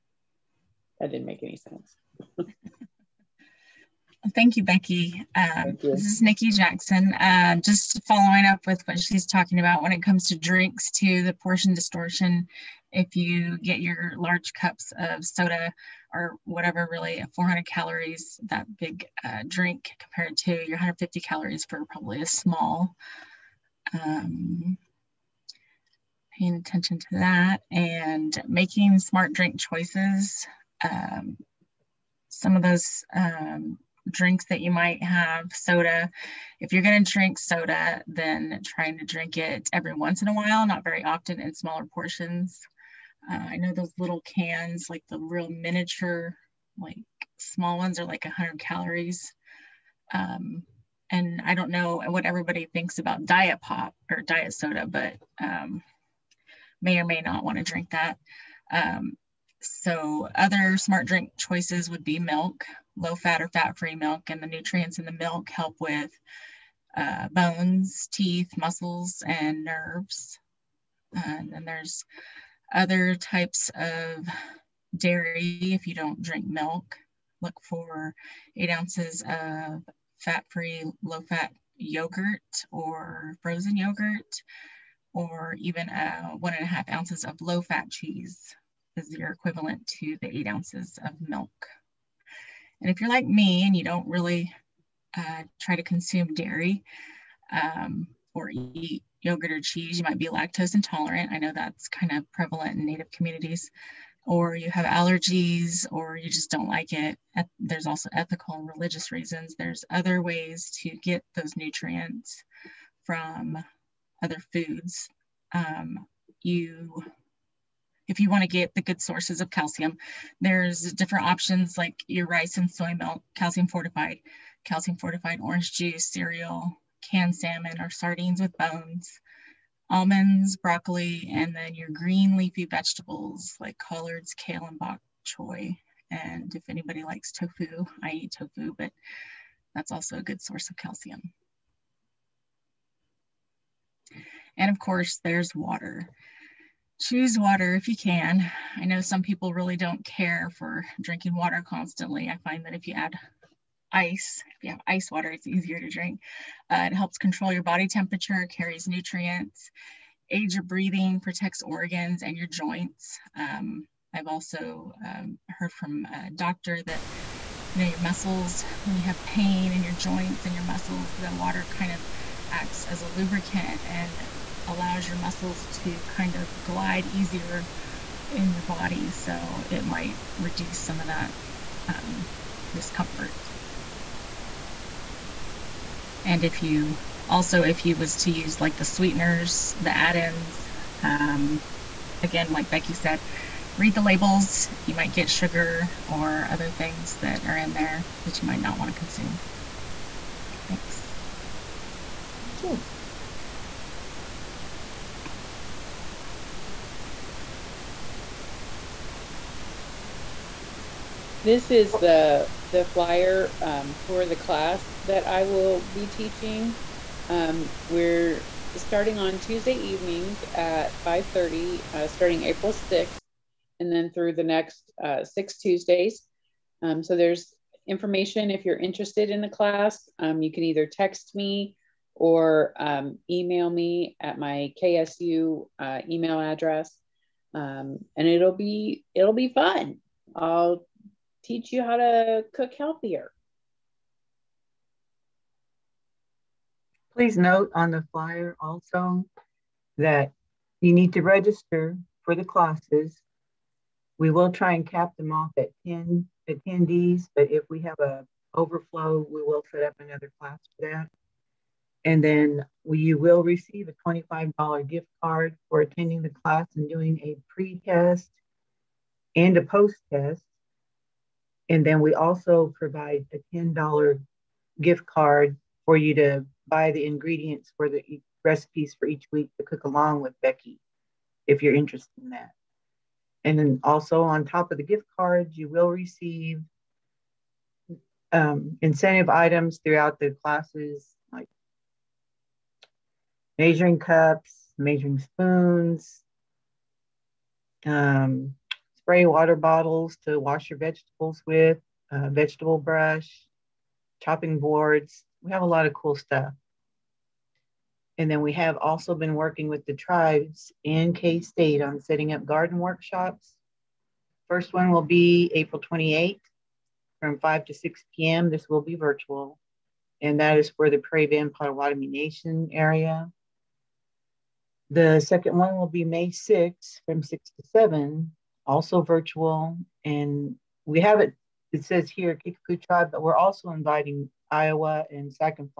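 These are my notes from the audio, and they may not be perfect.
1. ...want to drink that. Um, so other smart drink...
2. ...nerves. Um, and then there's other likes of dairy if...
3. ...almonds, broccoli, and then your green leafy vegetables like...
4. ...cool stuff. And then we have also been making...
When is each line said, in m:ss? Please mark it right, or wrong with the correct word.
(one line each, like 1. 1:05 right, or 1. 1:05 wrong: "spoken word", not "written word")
1. 0:57 right
2. 1:09 wrong: "types", not "likes"
3. 2:09 right
4. 5:05 wrong: "working", not "making".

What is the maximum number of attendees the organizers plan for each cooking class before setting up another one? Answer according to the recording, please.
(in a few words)
10.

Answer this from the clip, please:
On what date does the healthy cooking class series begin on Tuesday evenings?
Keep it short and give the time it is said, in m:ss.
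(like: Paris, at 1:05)
April 6th, at 3:42.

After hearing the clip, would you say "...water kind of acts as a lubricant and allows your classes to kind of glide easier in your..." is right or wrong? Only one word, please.
wrong.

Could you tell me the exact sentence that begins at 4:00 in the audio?
I'll teach you how to cook healthier.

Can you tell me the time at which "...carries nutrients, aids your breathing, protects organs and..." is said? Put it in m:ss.
2:38.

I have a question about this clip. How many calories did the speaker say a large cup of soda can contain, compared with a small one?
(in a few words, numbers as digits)
400.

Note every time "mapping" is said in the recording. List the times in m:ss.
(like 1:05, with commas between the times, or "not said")
not said.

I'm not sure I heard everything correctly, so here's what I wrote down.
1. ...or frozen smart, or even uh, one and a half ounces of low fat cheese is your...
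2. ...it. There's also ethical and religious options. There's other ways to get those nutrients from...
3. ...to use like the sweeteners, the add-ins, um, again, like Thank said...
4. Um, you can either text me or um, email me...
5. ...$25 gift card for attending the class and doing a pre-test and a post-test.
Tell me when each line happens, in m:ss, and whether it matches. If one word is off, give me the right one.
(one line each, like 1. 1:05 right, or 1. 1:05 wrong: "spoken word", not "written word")
1. 1:22 wrong: "yogurt", not "smart"
2. 1:46 wrong: "reasons", not "options"
3. 3:08 wrong: "Becky", not "Thank"
4. 3:50 right
5. 4:24 right.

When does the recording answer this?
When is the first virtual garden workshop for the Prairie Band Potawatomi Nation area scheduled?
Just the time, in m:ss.
5:15.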